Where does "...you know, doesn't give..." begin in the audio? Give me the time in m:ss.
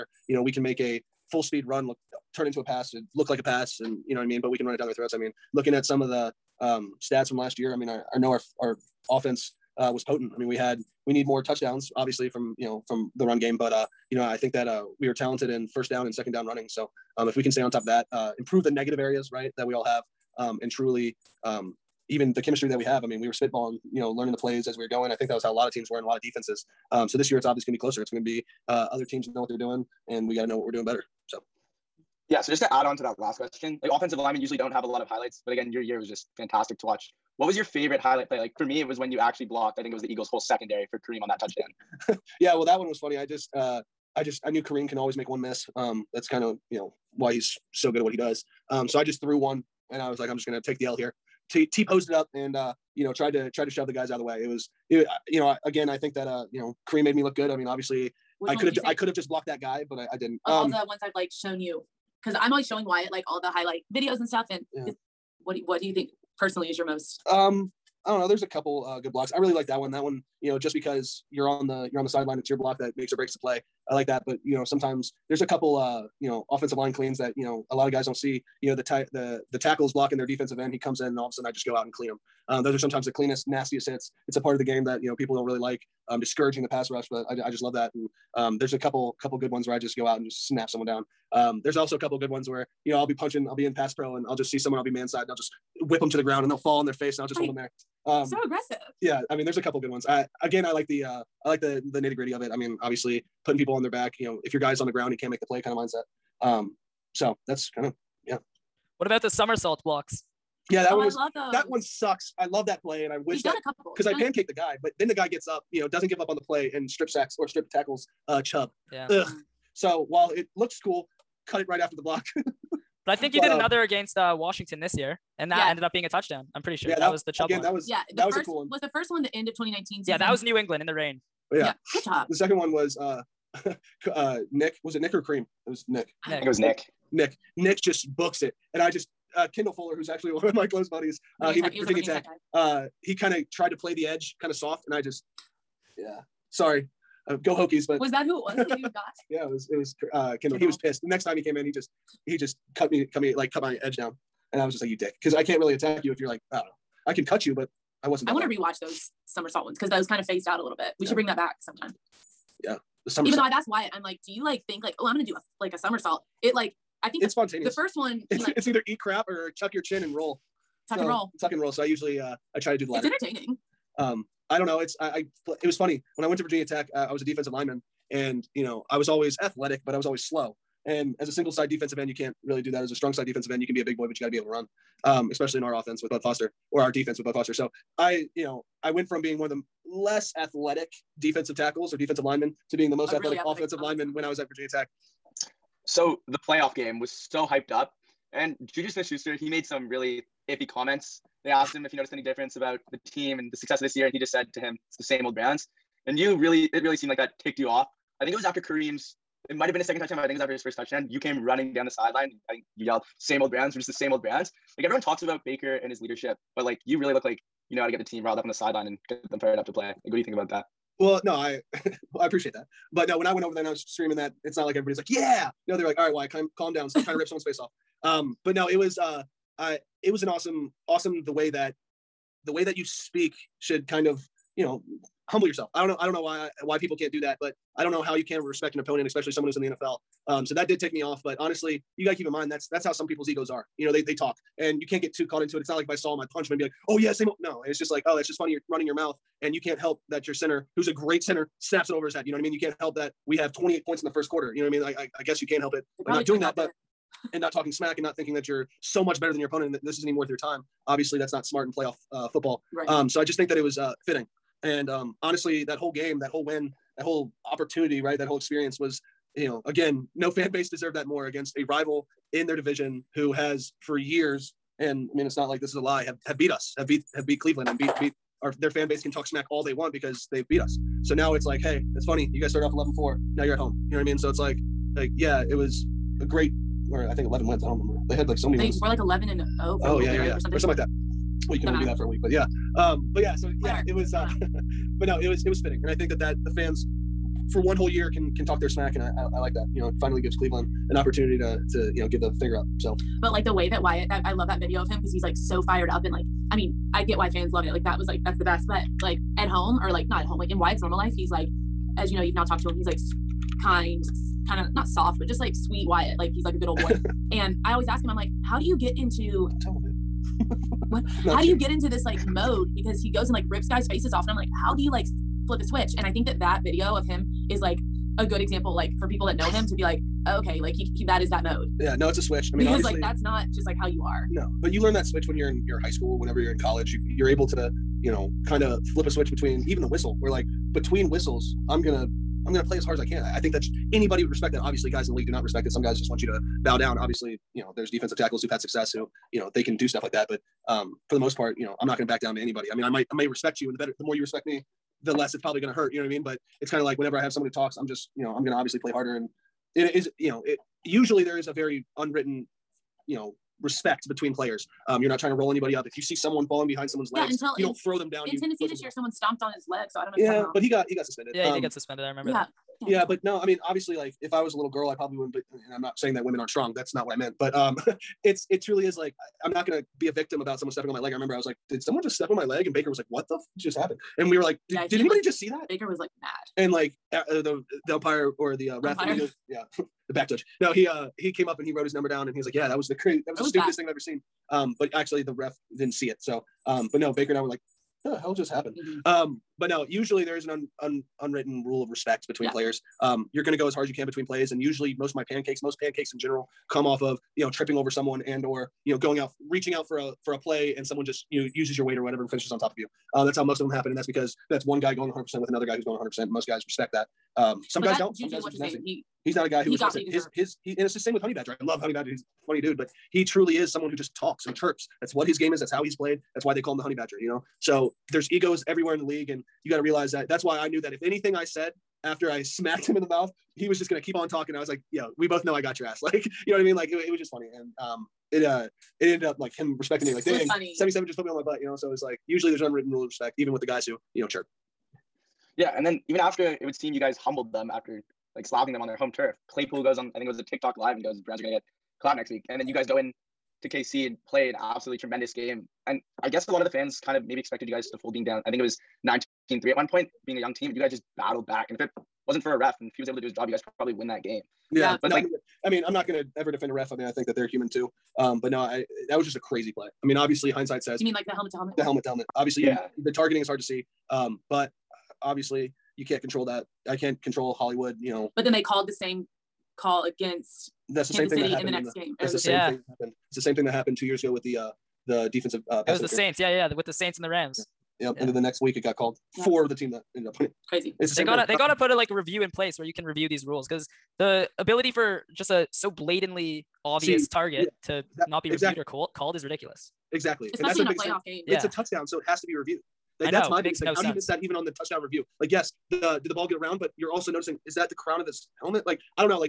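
1:55.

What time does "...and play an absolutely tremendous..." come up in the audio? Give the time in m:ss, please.
7:34.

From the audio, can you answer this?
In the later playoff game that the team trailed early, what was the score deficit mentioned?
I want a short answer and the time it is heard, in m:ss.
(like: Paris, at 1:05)
9-3, at 7:39.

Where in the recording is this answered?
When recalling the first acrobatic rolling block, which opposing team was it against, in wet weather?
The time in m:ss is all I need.
2:10.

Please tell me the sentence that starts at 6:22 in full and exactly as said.
And Baker was like, what the f- just happened?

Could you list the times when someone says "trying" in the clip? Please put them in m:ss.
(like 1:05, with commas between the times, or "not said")
3:47, 6:05.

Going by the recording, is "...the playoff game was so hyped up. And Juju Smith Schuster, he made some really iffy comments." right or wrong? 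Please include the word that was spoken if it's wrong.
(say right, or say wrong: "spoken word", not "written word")
right.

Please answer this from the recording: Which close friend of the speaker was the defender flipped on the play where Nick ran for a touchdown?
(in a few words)
Kendall Fuller.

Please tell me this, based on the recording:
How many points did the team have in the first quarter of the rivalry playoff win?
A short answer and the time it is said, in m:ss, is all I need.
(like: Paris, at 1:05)
28, at 4:13.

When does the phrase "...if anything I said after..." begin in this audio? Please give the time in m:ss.
7:10.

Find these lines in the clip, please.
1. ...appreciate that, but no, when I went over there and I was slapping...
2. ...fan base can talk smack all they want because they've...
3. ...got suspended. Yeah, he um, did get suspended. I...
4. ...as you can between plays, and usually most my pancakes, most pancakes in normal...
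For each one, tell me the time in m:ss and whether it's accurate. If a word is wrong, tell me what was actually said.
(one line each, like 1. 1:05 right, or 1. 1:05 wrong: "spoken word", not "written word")
1. 3:42 wrong: "screaming", not "slapping"
2. 4:38 right
3. 6:10 right
4. 6:43 wrong: "general", not "normal".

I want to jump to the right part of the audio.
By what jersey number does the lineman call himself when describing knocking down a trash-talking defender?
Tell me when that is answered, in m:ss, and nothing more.
7:20.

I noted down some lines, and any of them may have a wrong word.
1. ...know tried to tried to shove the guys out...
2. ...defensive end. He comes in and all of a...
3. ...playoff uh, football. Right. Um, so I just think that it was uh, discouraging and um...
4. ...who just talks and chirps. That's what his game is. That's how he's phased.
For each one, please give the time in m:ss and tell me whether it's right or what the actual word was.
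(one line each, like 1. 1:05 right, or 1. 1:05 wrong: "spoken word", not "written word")
1. 0:53 right
2. 1:20 right
3. 4:21 wrong: "fitting", not "discouraging"
4. 7:03 wrong: "played", not "phased".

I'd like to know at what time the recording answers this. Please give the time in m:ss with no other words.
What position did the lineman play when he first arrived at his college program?
2:57.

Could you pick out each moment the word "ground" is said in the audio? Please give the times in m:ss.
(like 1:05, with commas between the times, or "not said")
1:36, 1:44.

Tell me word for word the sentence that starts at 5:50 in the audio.
But um, for the most part, you know, I'm not going to back down to anybody.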